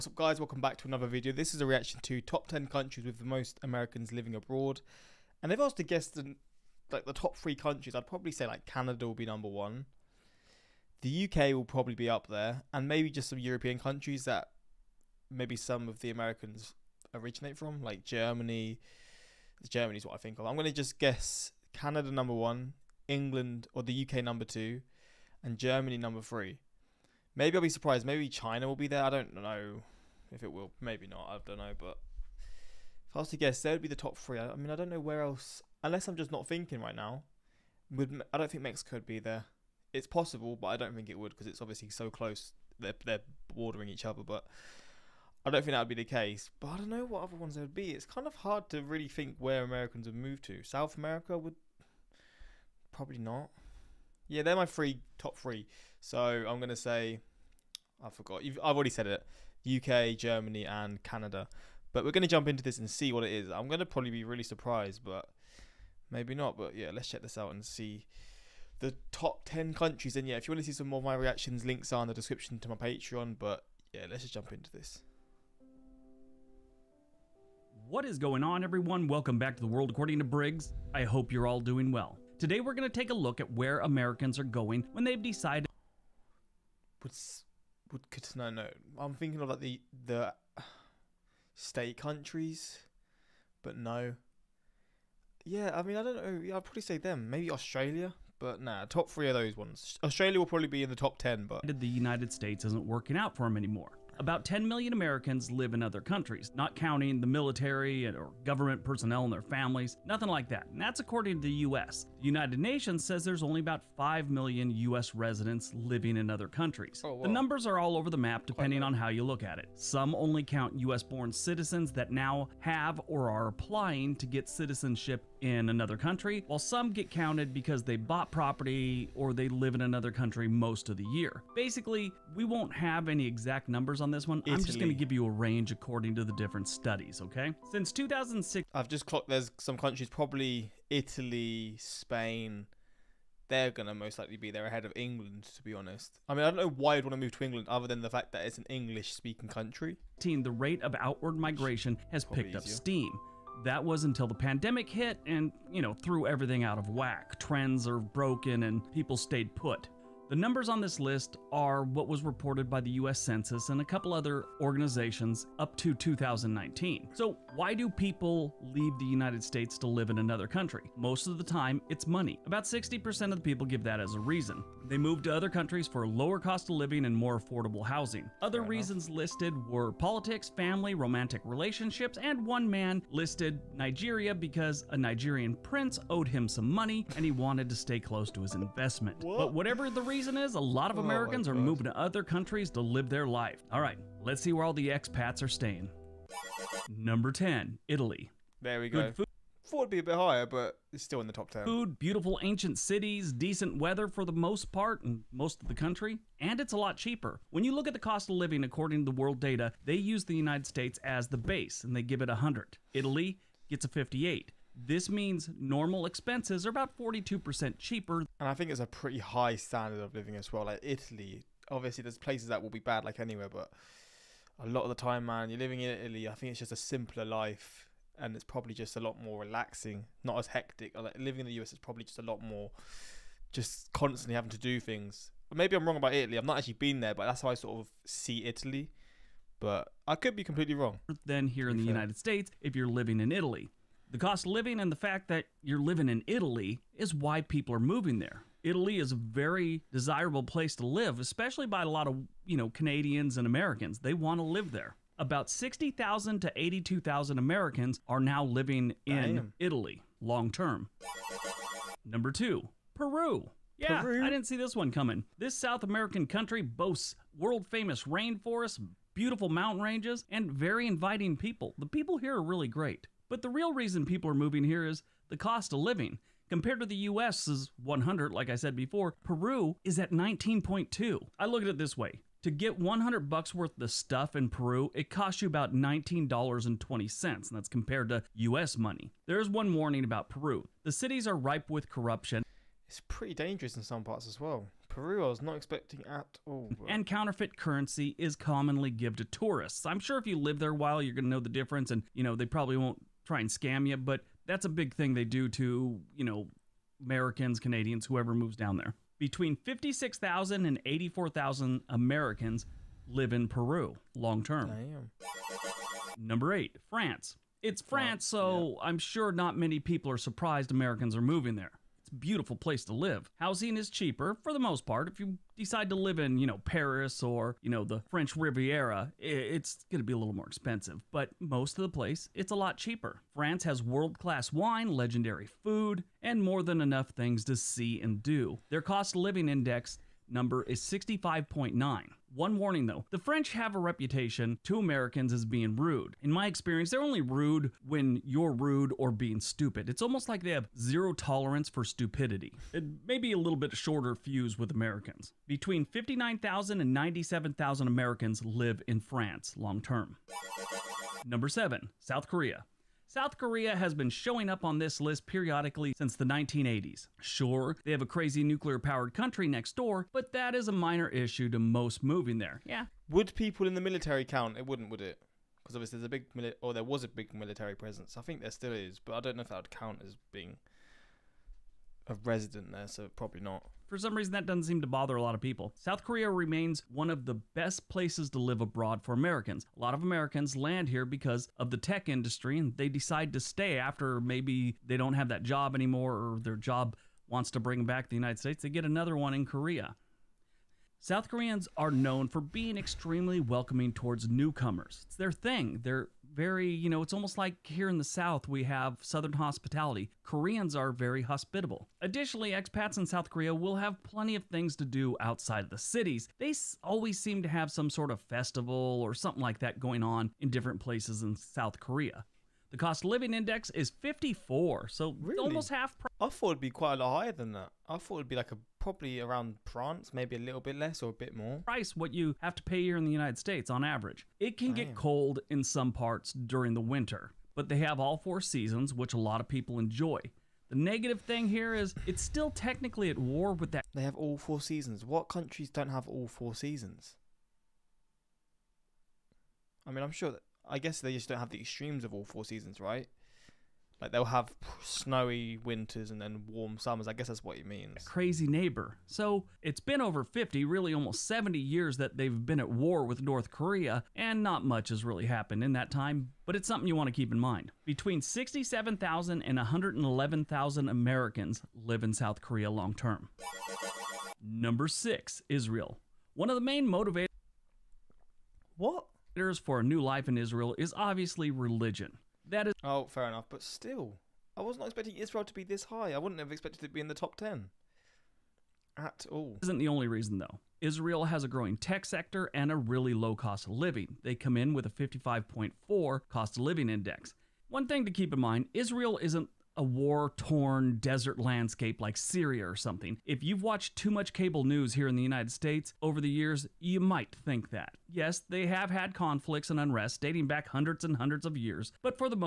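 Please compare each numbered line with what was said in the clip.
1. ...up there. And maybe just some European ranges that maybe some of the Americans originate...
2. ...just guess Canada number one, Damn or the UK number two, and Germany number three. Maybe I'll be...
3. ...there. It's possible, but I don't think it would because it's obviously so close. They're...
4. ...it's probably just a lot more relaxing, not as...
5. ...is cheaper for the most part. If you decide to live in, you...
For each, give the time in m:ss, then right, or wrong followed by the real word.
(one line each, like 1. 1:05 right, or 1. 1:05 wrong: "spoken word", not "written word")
1. 0:12 wrong: "countries", not "ranges"
2. 0:20 wrong: "England", not "Damn"
3. 0:39 right
4. 3:48 right
5. 5:23 right.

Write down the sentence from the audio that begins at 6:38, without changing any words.
They get another one in Korea.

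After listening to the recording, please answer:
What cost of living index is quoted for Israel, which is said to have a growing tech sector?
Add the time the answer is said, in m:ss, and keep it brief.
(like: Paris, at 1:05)
55.4, at 8:14.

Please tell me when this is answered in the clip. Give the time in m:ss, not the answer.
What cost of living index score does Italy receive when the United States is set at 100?
3:33.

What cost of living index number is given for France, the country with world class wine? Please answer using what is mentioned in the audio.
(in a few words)
65.9.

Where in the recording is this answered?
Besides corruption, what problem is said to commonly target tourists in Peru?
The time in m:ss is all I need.
4:57.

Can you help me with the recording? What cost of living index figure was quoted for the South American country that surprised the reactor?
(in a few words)
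19.2.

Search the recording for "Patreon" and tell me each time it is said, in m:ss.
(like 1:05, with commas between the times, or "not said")
1:12.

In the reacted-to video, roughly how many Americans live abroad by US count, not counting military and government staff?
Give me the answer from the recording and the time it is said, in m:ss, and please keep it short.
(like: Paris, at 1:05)
10 million, at 1:44.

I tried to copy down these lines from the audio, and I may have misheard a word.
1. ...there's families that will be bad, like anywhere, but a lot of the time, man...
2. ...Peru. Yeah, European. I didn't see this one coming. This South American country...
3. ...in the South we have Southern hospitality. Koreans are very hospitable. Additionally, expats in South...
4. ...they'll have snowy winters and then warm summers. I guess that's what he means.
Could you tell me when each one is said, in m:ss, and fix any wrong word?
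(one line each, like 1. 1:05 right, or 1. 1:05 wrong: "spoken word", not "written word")
1. 3:42 wrong: "places", not "families"
2. 4:22 wrong: "Peru", not "European"
3. 6:47 right
4. 7:34 right.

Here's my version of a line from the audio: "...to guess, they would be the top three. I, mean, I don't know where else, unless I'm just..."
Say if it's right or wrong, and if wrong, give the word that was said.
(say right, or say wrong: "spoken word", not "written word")
right.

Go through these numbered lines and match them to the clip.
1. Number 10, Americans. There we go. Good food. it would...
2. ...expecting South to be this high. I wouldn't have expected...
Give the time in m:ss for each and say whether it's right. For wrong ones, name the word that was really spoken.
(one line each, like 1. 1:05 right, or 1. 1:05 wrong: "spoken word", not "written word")
1. 3:16 wrong: "Italy", not "Americans"
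2. 8:04 wrong: "Israel", not "South".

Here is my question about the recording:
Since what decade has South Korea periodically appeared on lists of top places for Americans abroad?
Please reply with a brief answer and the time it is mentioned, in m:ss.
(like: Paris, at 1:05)
1980s, at 6:06.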